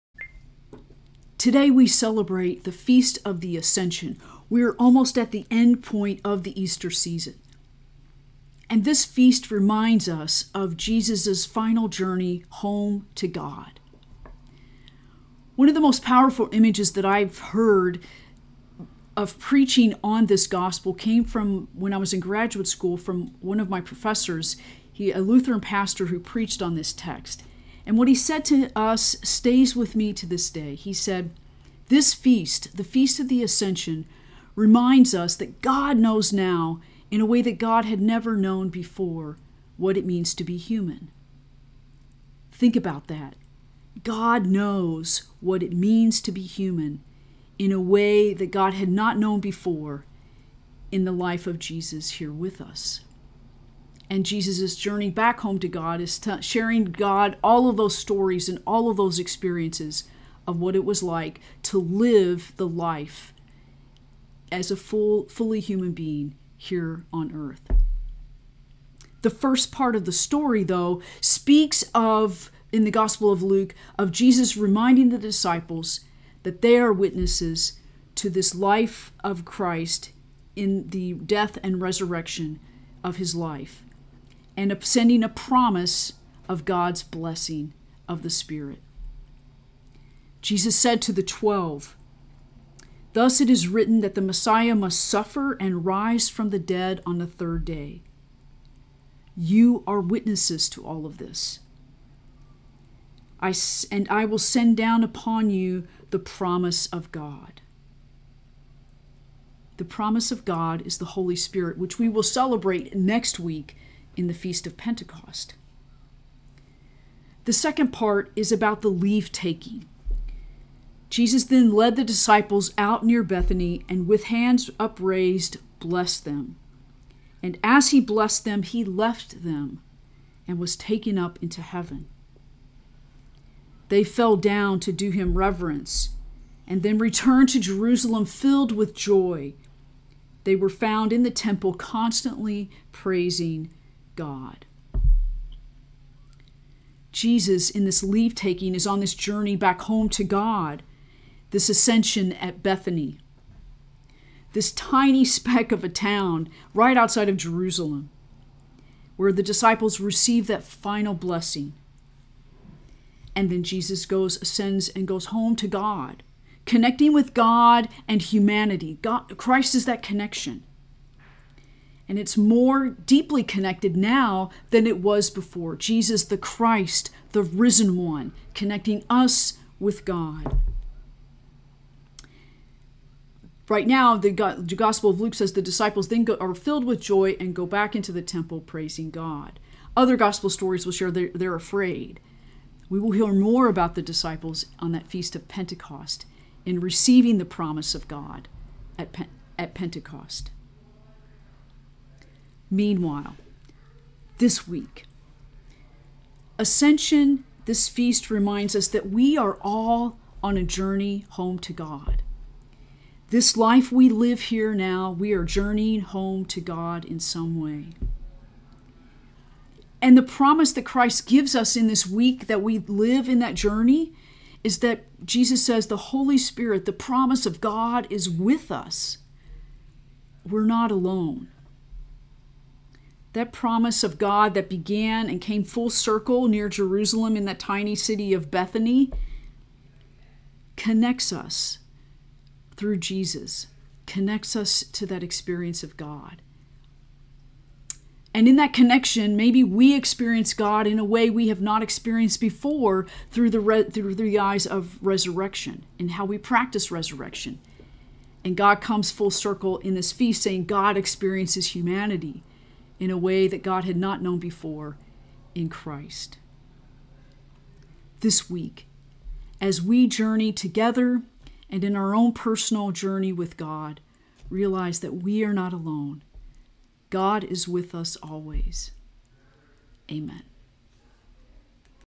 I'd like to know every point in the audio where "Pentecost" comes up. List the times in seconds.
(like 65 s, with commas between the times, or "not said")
114 s, 195 s, 199 s.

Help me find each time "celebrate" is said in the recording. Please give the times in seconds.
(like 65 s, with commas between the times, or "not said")
1 s, 112 s.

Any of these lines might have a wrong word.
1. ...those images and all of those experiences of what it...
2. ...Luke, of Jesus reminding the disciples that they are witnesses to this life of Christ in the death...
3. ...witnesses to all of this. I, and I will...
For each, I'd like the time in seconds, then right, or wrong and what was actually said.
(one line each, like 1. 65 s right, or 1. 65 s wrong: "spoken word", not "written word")
1. 57 s wrong: "stories", not "images"
2. 73 s right
3. 100 s right.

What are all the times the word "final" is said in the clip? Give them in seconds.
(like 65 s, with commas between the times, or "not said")
11 s, 160 s.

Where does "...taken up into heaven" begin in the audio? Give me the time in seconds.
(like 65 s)
130 s.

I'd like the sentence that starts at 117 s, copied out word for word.
The second part is about the leave taking.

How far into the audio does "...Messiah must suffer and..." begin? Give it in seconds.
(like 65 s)
94 s.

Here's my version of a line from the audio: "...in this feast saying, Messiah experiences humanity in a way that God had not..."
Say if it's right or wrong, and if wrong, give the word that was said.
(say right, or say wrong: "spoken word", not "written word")
wrong: "God", not "Messiah".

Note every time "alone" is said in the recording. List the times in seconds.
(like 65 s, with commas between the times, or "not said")
230 s, 275 s.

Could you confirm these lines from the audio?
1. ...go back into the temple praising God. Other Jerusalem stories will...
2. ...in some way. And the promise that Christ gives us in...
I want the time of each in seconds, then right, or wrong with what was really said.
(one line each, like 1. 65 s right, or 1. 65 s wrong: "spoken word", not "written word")
1. 187 s wrong: "Gospel", not "Jerusalem"
2. 217 s right.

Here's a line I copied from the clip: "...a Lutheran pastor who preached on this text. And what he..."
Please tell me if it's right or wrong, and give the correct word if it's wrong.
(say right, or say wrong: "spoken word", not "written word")
right.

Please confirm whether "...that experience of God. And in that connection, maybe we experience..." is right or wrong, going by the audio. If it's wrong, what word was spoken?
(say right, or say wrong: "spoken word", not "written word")
right.